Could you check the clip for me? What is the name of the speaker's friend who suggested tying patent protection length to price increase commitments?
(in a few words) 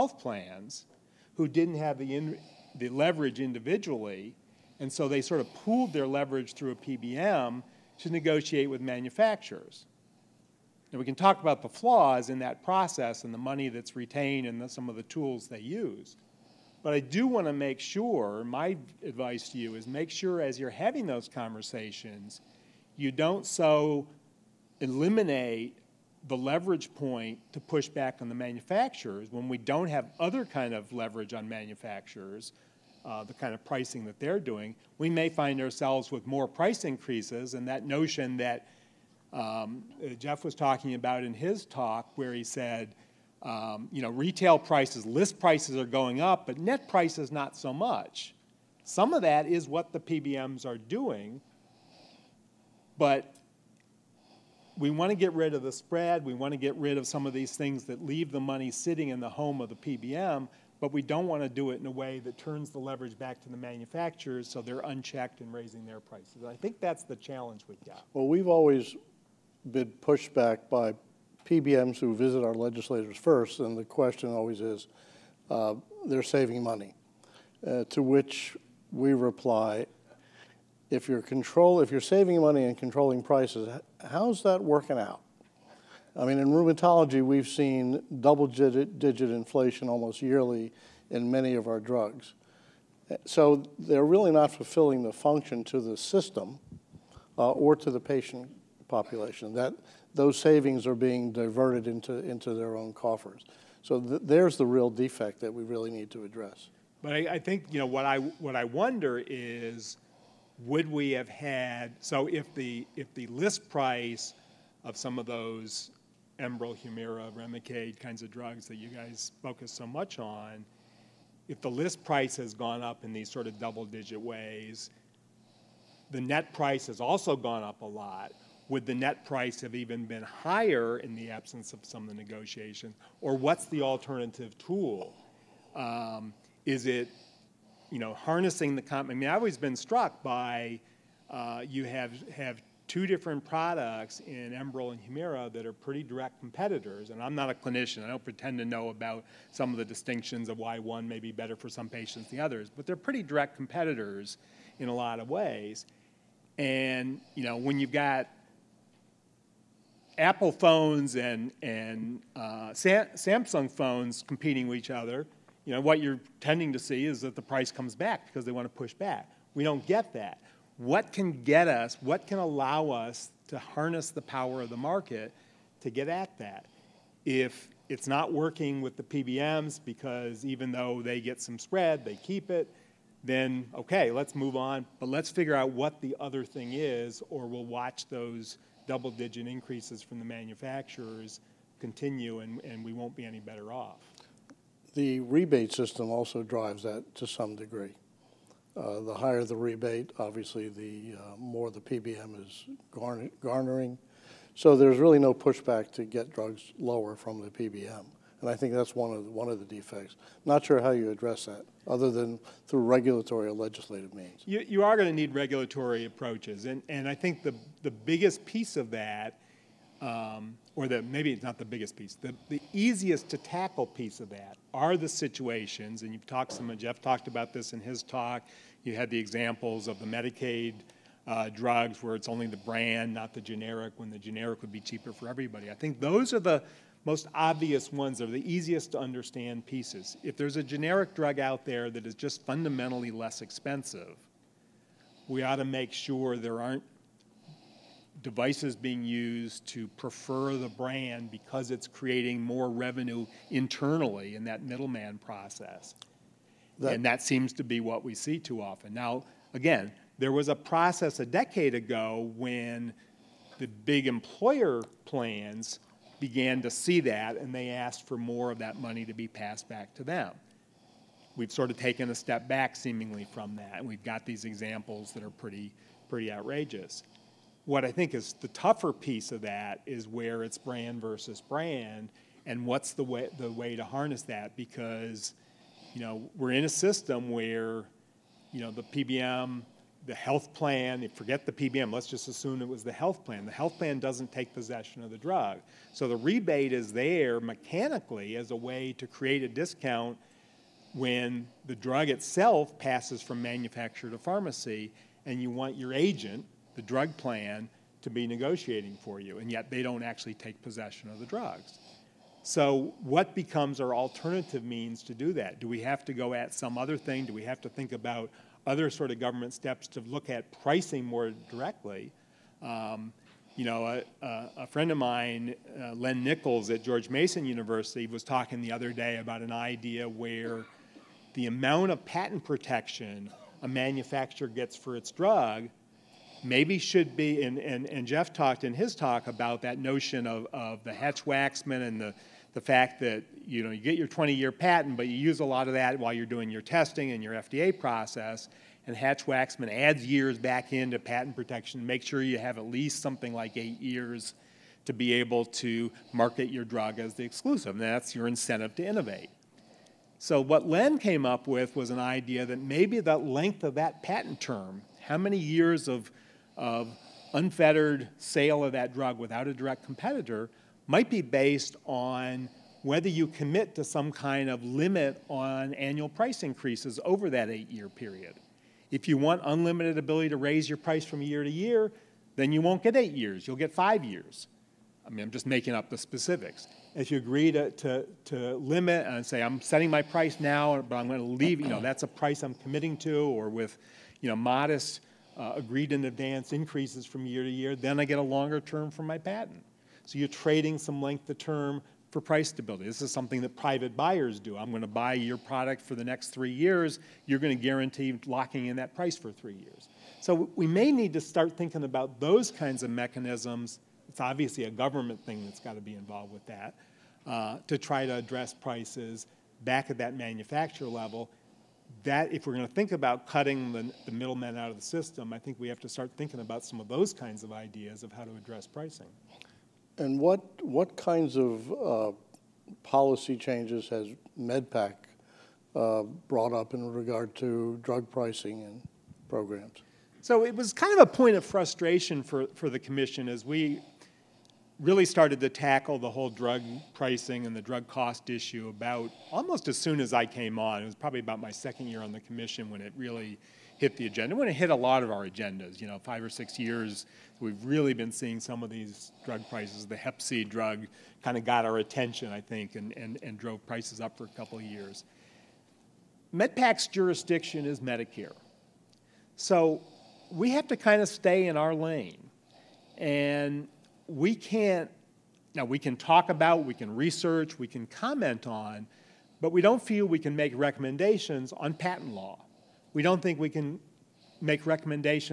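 Len Nichols.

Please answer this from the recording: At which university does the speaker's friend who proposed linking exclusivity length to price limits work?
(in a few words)
George Mason University.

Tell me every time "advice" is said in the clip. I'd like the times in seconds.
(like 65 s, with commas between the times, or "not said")
19 s.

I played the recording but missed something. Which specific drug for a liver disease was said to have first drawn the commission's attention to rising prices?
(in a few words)
Hep C drug.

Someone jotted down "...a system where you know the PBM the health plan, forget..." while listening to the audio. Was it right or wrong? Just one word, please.
right.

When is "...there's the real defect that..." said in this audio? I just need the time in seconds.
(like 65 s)
104 s.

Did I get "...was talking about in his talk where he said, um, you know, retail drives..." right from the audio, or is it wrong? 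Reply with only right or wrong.
wrong.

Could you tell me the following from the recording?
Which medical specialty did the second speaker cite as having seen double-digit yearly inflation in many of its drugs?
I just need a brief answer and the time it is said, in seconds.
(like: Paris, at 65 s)
Rheumatology, at 86 s.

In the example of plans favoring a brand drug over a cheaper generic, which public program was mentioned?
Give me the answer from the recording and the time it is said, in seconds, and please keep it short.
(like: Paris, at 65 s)
Medicaid, at 230 s.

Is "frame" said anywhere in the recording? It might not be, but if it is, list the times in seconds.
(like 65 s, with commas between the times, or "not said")
not said.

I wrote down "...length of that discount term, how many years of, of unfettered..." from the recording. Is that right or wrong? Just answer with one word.
wrong.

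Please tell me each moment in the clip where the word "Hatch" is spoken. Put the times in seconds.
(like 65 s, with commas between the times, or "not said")
340 s, 348 s.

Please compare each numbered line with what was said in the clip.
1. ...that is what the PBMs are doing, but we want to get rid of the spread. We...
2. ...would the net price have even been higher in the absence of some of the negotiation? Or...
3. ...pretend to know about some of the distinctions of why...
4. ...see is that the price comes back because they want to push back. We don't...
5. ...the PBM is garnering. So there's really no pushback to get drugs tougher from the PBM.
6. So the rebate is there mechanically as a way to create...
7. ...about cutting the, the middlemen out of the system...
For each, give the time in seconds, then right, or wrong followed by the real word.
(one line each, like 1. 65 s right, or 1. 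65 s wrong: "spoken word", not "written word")
1. 49 s right
2. 128 s right
3. 148 s right
4. 166 s right
5. 201 s wrong: "lower", not "tougher"
6. 295 s right
7. 422 s right.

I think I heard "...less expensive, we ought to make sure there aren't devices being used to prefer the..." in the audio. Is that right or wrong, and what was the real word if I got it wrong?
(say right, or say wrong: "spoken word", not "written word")
right.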